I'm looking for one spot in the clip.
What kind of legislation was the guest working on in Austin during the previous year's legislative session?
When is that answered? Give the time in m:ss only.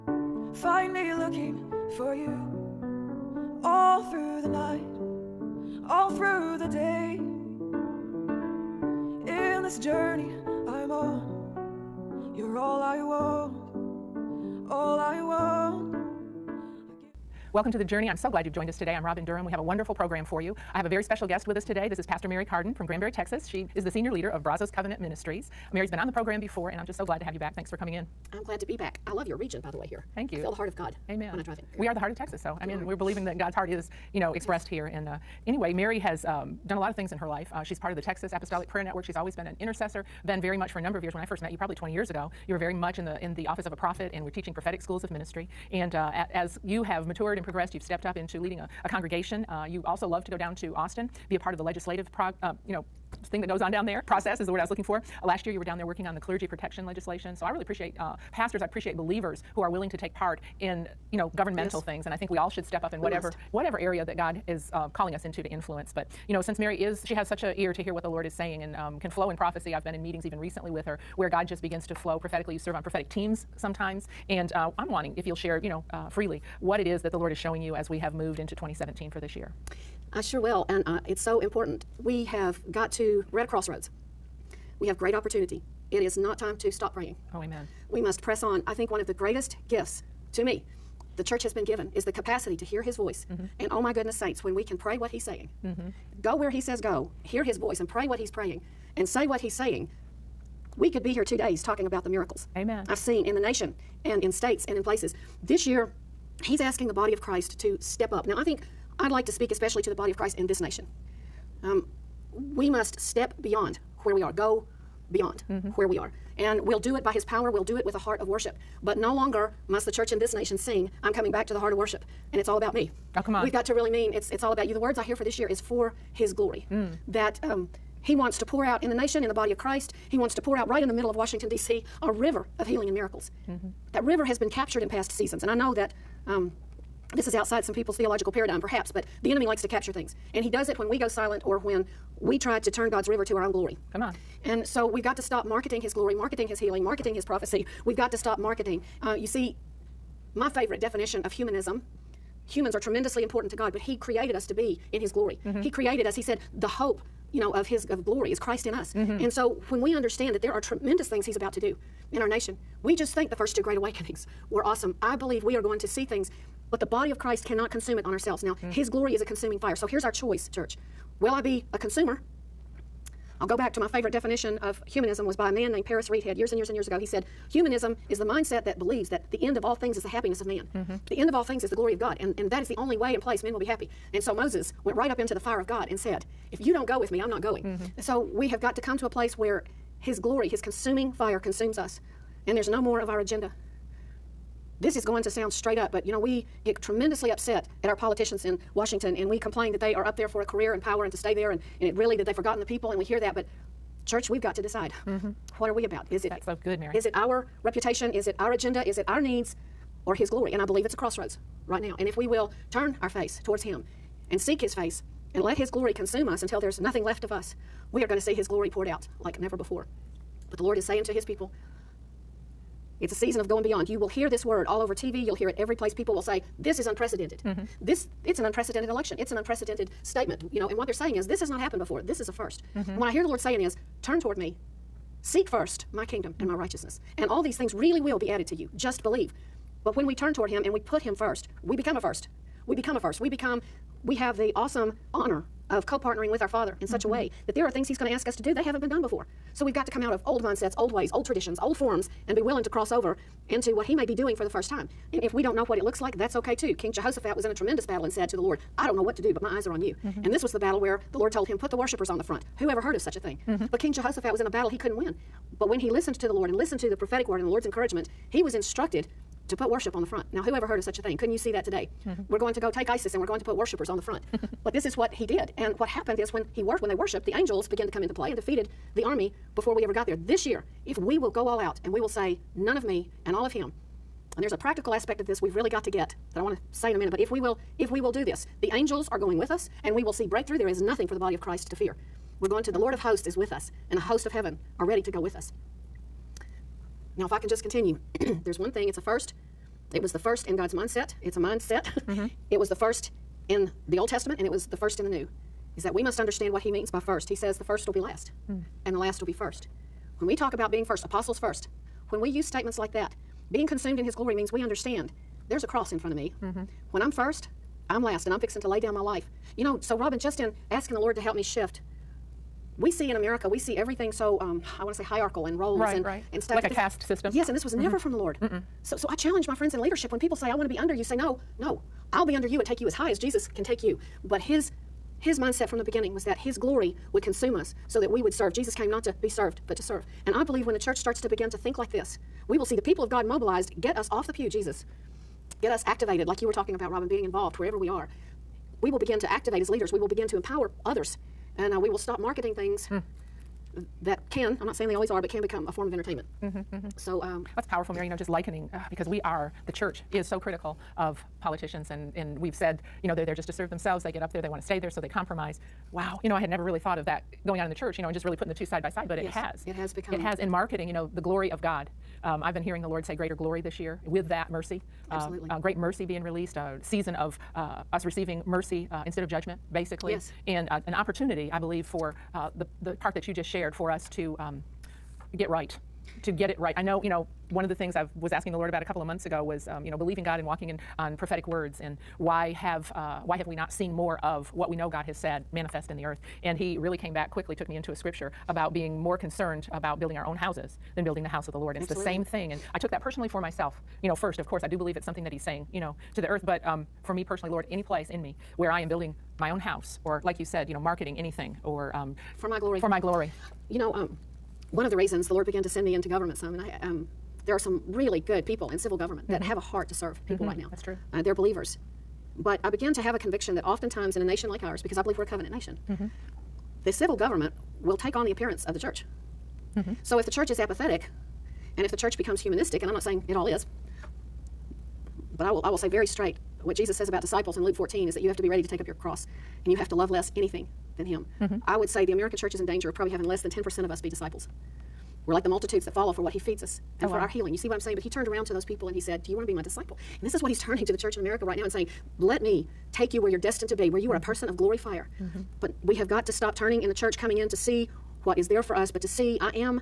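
0:56.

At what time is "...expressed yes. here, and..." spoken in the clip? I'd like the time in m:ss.
0:34.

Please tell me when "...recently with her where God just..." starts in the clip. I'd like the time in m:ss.
1:10.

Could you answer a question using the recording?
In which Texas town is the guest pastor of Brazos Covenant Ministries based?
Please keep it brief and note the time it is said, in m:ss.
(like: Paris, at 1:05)
Granbury, at 0:22.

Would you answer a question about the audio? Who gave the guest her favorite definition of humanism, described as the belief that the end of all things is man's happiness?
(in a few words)
Paris Reidhead.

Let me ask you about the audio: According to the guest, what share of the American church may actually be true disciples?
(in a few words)
Less than 10%.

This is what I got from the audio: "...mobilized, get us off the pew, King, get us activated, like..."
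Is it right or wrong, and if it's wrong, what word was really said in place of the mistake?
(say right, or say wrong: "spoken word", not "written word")
wrong: "Jesus", not "King".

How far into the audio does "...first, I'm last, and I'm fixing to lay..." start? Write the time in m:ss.
5:17.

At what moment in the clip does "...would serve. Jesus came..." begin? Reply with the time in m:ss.
5:38.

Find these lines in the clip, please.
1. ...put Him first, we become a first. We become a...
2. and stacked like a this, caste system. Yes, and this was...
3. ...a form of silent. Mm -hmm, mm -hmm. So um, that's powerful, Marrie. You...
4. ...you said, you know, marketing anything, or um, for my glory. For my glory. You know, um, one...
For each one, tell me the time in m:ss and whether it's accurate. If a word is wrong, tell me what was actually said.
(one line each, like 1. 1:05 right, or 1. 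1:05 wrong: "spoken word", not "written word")
1. 4:00 right
2. 5:26 right
3. 5:55 wrong: "entertainment", not "silent"
4. 6:50 right.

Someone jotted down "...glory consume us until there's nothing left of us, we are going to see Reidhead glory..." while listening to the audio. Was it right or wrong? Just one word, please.
wrong.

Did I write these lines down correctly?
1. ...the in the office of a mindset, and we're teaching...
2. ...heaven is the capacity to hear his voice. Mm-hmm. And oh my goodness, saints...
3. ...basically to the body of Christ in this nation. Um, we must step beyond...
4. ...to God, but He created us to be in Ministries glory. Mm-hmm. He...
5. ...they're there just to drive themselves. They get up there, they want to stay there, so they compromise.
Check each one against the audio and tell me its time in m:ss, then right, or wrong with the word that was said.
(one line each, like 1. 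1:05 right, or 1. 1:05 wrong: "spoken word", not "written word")
1. 0:43 wrong: "prophet", not "mindset"
2. 1:31 wrong: "given", not "heaven"
3. 1:49 wrong: "especially", not "basically"
4. 2:33 wrong: "His", not "Ministries"
5. 6:03 wrong: "serve", not "drive".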